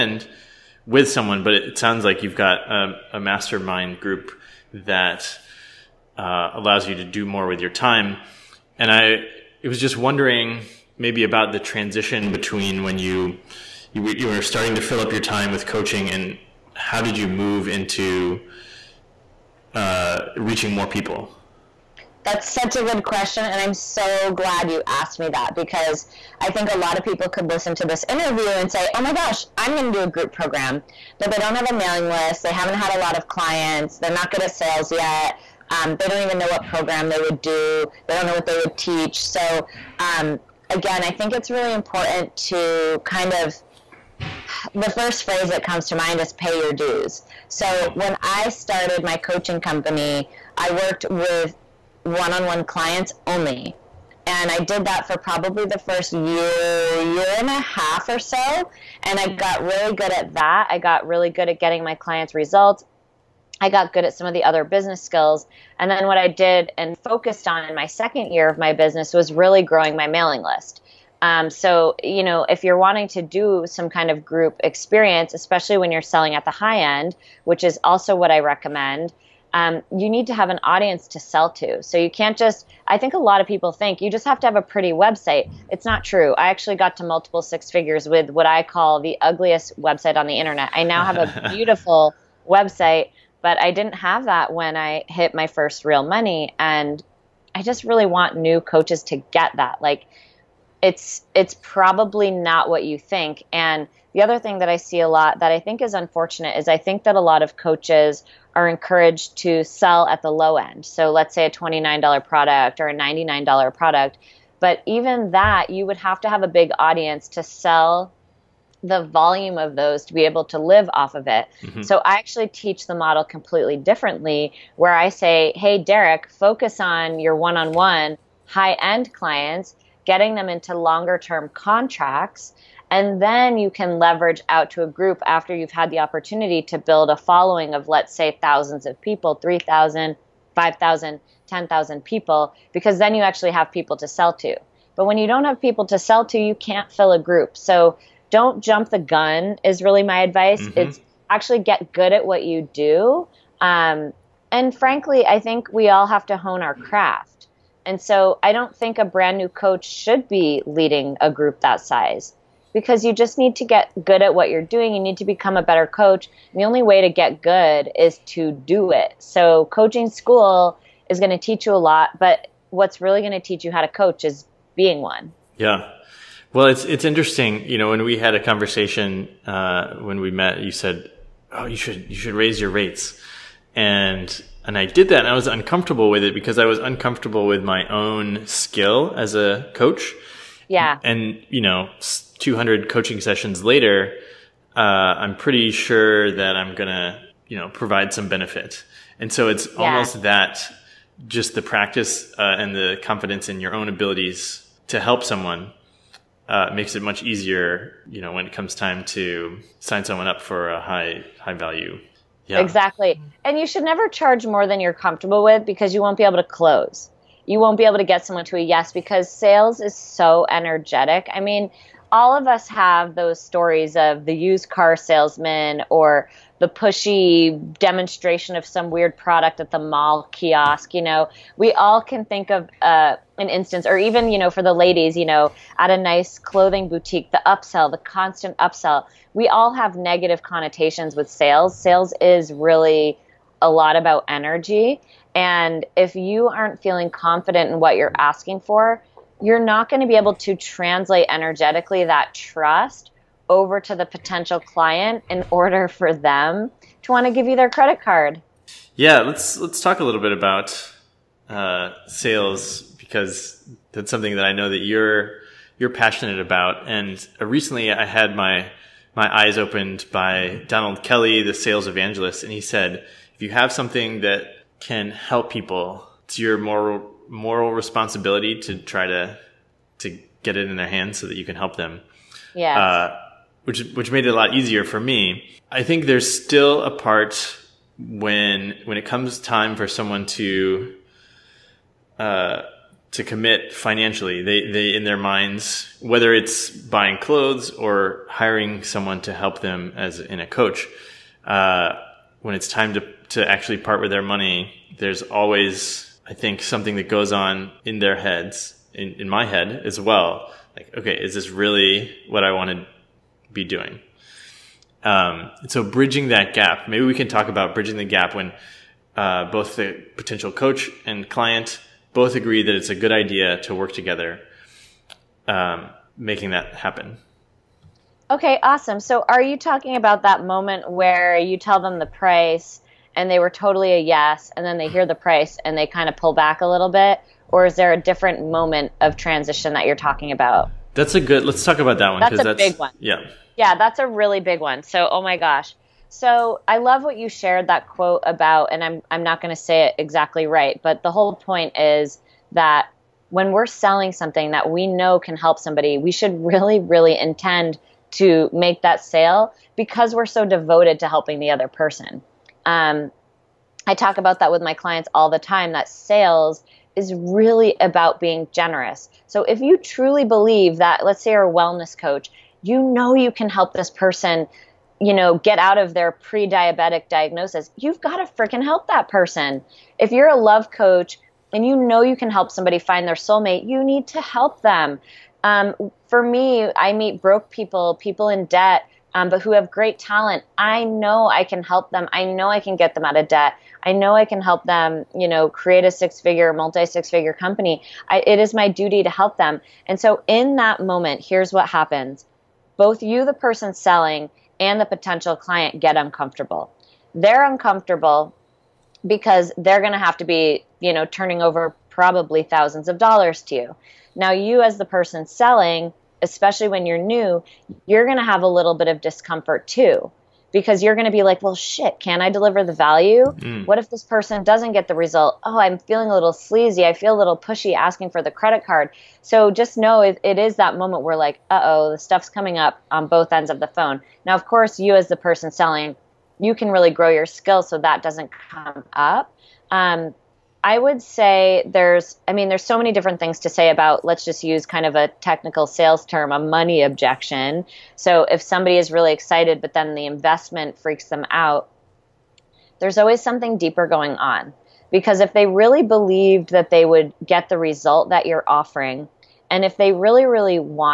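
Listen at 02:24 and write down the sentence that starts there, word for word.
But when you don't have people to sell to, you can't fill a group.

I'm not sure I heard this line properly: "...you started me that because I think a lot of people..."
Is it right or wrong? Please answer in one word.
wrong.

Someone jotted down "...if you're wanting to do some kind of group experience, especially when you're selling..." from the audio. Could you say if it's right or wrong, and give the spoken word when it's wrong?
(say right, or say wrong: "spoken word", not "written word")
right.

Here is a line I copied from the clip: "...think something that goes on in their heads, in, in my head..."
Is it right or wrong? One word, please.
right.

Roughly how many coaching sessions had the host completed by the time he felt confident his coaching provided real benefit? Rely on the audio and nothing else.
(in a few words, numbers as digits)
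200.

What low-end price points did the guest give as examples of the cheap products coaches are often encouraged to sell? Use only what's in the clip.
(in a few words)
$29 or $99.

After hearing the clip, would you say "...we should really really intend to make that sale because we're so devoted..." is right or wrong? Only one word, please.
right.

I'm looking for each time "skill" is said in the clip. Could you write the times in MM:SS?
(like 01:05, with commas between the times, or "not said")
01:05, 03:08, 07:17.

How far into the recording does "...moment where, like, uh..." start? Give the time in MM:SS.
07:10.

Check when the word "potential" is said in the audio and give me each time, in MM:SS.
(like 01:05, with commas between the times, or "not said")
04:14, 05:20, 06:44.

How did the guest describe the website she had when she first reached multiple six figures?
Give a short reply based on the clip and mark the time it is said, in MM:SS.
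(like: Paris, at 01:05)
ugliest website on the internet, at 01:29.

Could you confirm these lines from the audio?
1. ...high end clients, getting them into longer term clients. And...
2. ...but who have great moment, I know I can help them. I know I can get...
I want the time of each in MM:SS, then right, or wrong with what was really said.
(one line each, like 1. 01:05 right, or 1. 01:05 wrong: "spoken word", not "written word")
1. 02:08 wrong: "contracts", not "clients"
2. 06:29 wrong: "talent", not "moment".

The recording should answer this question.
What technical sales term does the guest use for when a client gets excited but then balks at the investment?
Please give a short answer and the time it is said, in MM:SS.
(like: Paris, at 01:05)
money objection, at 07:26.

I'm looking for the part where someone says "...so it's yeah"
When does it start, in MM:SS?
03:19.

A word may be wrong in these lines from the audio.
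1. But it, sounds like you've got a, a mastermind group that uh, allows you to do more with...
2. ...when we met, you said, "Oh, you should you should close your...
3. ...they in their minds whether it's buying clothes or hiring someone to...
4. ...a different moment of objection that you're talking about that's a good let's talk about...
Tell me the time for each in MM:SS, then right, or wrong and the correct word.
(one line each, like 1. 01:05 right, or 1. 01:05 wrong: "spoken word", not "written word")
1. 00:01 right
2. 02:59 wrong: "raise", not "close"
3. 04:54 right
4. 05:37 wrong: "transition", not "objection".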